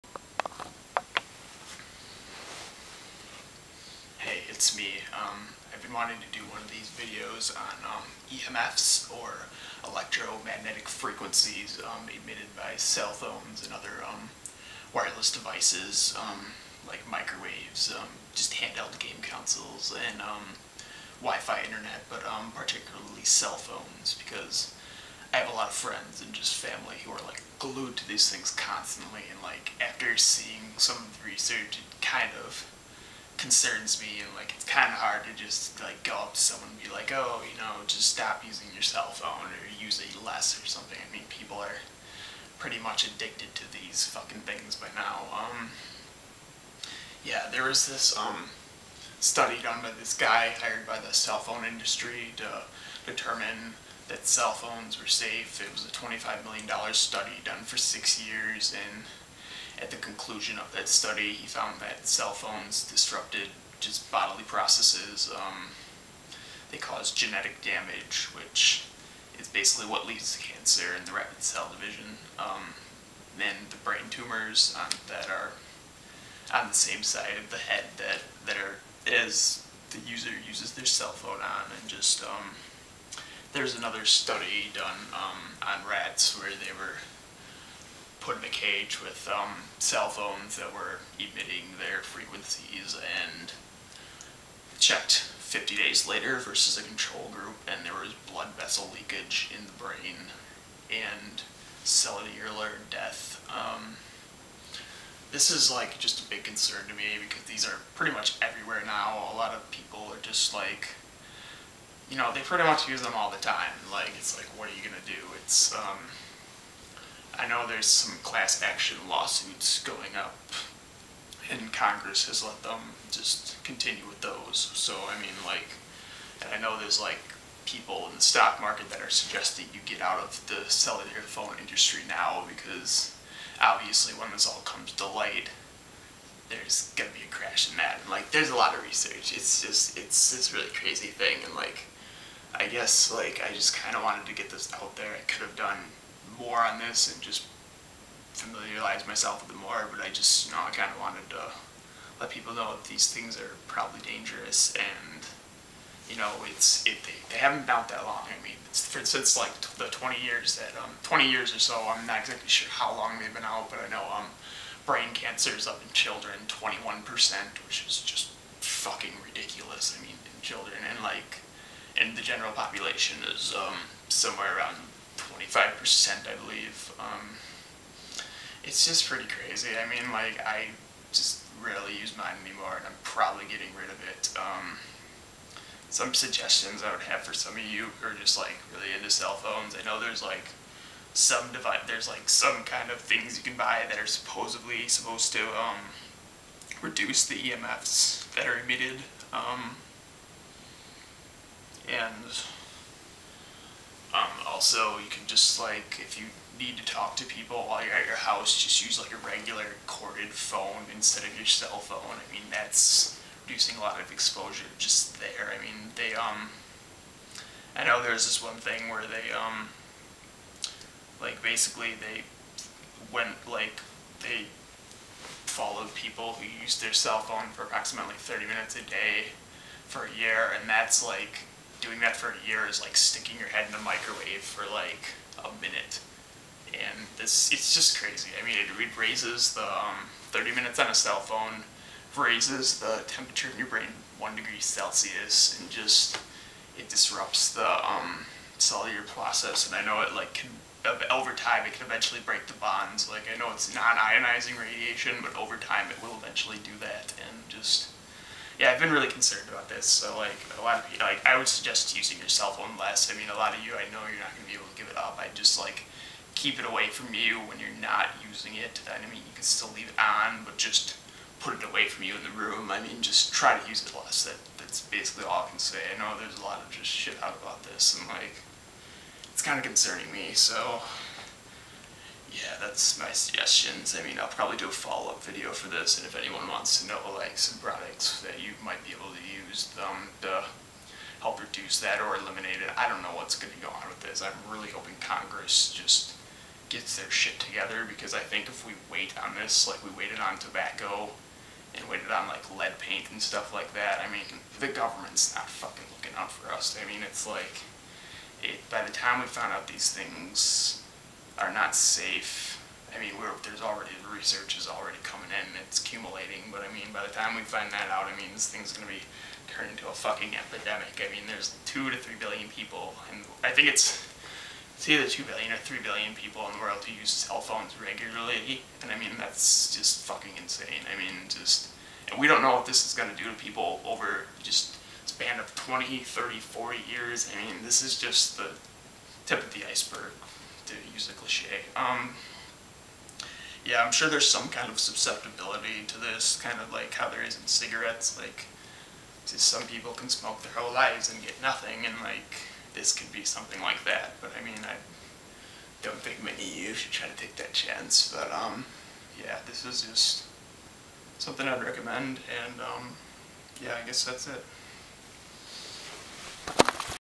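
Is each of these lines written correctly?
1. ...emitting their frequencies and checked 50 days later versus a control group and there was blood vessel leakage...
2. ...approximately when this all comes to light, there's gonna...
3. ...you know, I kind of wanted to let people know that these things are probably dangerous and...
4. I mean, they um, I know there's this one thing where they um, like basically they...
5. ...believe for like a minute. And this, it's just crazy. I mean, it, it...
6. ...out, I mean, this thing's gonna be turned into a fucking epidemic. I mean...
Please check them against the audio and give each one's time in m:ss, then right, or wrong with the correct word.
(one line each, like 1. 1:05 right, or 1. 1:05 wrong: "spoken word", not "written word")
1. 1:31 right
2. 2:13 wrong: "obviously", not "approximately"
3. 2:30 right
4. 3:35 right
5. 3:53 wrong: "microwave", not "believe"
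6. 5:17 right.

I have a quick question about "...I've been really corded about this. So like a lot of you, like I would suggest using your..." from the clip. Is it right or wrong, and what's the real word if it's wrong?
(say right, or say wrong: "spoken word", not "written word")
wrong: "concerned", not "corded".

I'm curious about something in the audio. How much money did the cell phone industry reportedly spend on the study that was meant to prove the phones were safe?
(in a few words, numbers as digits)
$25 million.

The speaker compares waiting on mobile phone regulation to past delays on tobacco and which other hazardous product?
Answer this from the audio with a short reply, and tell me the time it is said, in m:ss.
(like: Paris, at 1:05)
lead paint, at 5:02.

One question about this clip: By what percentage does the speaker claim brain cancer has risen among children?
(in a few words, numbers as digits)
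21%.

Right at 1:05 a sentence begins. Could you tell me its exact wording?
Um, they cause genetic damage, which is basically what leads to cancer and the rapid cell division.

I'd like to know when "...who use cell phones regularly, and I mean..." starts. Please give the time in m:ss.
5:26.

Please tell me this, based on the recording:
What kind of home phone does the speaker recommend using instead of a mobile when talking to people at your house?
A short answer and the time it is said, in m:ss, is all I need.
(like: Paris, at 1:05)
corded phone, at 3:29.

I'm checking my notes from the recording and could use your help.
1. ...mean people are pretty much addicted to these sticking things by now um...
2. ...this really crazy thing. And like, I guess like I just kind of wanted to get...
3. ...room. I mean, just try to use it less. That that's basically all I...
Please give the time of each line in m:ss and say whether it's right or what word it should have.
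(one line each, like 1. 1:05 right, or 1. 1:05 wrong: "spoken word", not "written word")
1. 0:41 wrong: "fucking", not "sticking"
2. 2:20 right
3. 4:32 right.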